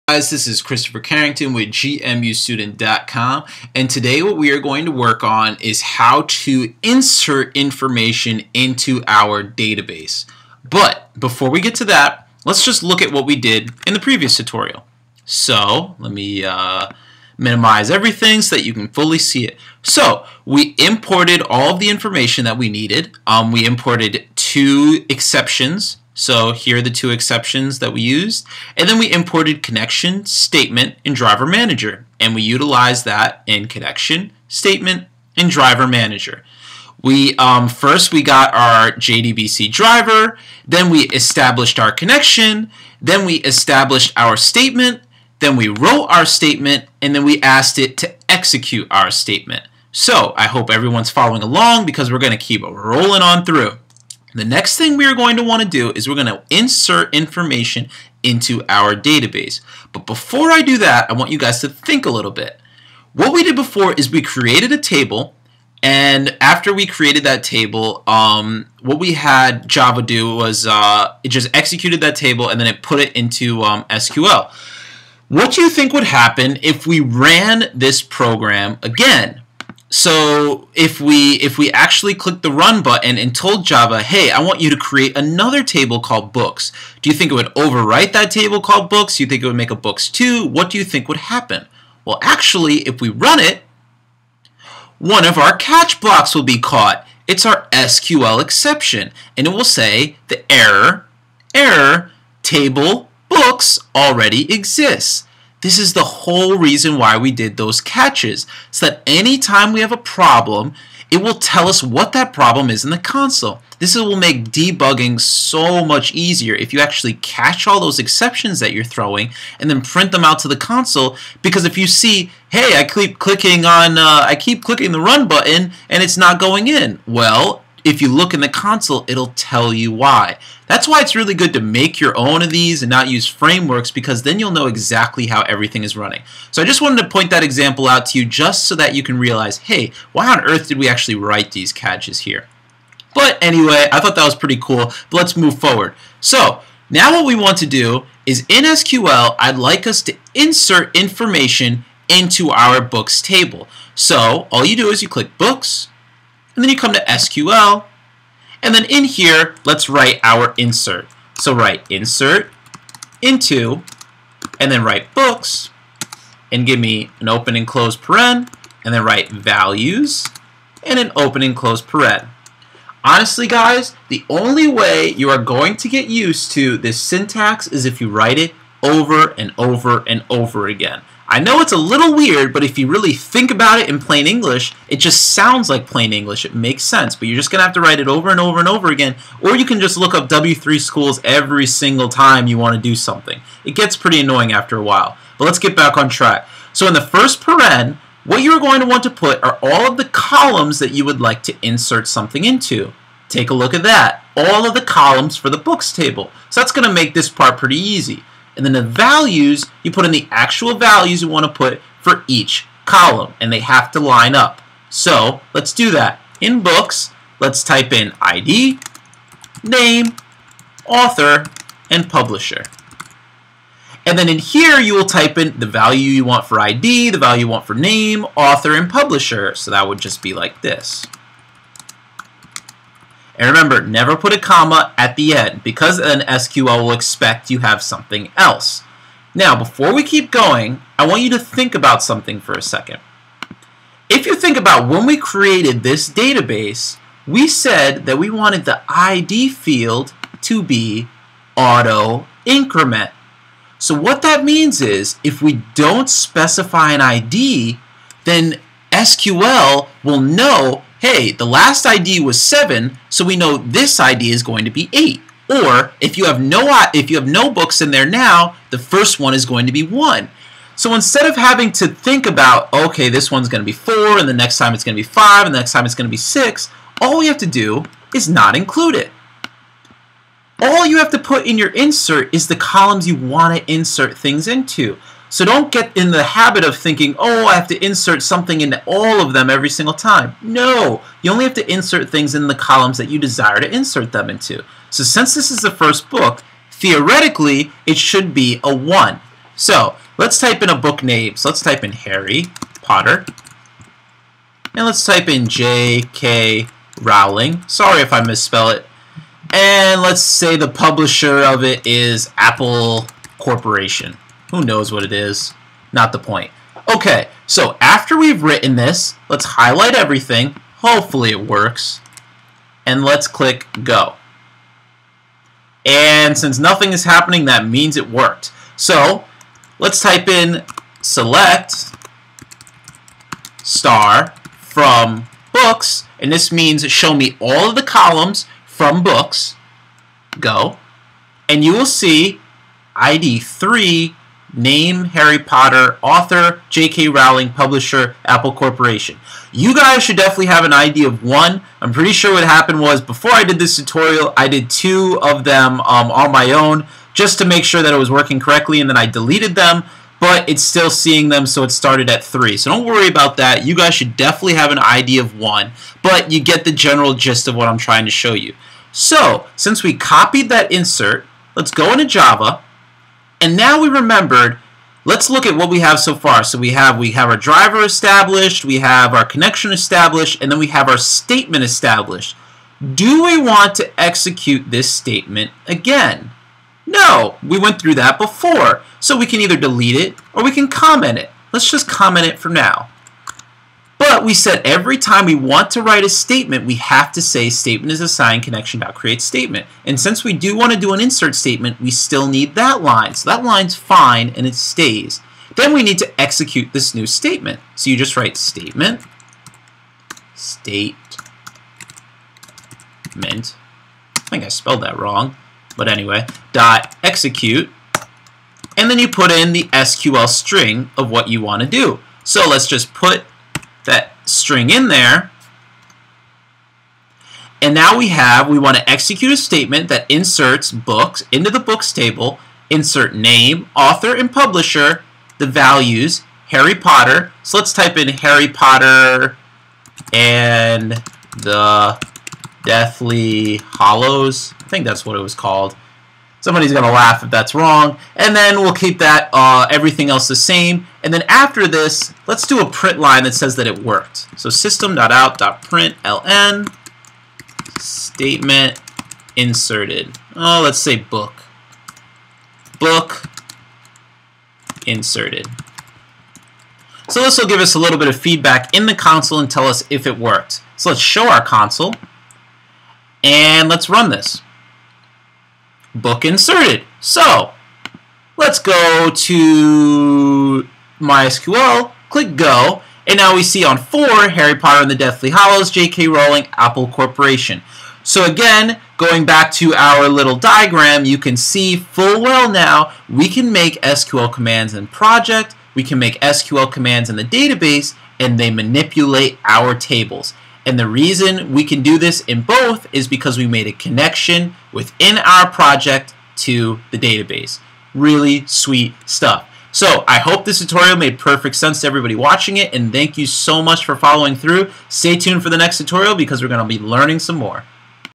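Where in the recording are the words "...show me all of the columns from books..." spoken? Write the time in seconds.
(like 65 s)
336 s.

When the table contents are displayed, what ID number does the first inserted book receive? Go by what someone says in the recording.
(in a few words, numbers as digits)
3.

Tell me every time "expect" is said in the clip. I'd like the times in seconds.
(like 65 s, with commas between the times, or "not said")
236 s.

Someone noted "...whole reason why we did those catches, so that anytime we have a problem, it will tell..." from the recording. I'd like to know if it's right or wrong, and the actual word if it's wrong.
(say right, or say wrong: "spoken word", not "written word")
right.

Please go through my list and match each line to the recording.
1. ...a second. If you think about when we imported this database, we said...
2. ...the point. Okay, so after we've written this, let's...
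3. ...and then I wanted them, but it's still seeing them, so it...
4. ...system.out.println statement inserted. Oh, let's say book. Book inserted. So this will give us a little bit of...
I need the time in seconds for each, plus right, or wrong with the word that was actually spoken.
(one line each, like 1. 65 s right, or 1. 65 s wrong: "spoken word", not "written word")
1. 242 s wrong: "created", not "imported"
2. 316 s right
3. 358 s wrong: "deleted", not "wanted"
4. 454 s right.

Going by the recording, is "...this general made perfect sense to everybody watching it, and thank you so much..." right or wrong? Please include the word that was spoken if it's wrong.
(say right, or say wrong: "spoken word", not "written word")
wrong: "tutorial", not "general".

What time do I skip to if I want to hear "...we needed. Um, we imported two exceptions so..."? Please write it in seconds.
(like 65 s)
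22 s.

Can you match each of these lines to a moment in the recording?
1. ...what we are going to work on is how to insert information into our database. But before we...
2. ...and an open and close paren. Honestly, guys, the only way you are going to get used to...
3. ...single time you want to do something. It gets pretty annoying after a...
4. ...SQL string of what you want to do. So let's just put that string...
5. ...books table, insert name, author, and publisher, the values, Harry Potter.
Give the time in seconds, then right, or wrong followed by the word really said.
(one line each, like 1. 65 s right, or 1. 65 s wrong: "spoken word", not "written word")
1. 4 s right
2. 170 s right
3. 191 s right
4. 419 s right
5. 431 s right.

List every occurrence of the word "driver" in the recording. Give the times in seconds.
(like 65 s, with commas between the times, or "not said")
31 s, 35 s, 39 s, 377 s.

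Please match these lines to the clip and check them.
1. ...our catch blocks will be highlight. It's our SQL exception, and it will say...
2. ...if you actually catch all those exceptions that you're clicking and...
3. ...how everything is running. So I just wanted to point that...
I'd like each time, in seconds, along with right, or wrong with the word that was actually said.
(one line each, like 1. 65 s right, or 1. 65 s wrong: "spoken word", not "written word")
1. 95 s wrong: "caught", not "highlight"
2. 116 s wrong: "throwing", not "clicking"
3. 135 s right.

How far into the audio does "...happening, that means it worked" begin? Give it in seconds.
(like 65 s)
327 s.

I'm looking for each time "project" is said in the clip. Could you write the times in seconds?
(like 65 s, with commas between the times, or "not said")
494 s, 505 s.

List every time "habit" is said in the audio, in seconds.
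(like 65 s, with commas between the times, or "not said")
286 s.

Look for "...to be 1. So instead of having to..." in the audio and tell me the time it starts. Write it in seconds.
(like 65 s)
269 s.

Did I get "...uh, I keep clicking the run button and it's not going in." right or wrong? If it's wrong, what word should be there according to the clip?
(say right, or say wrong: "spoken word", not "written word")
right.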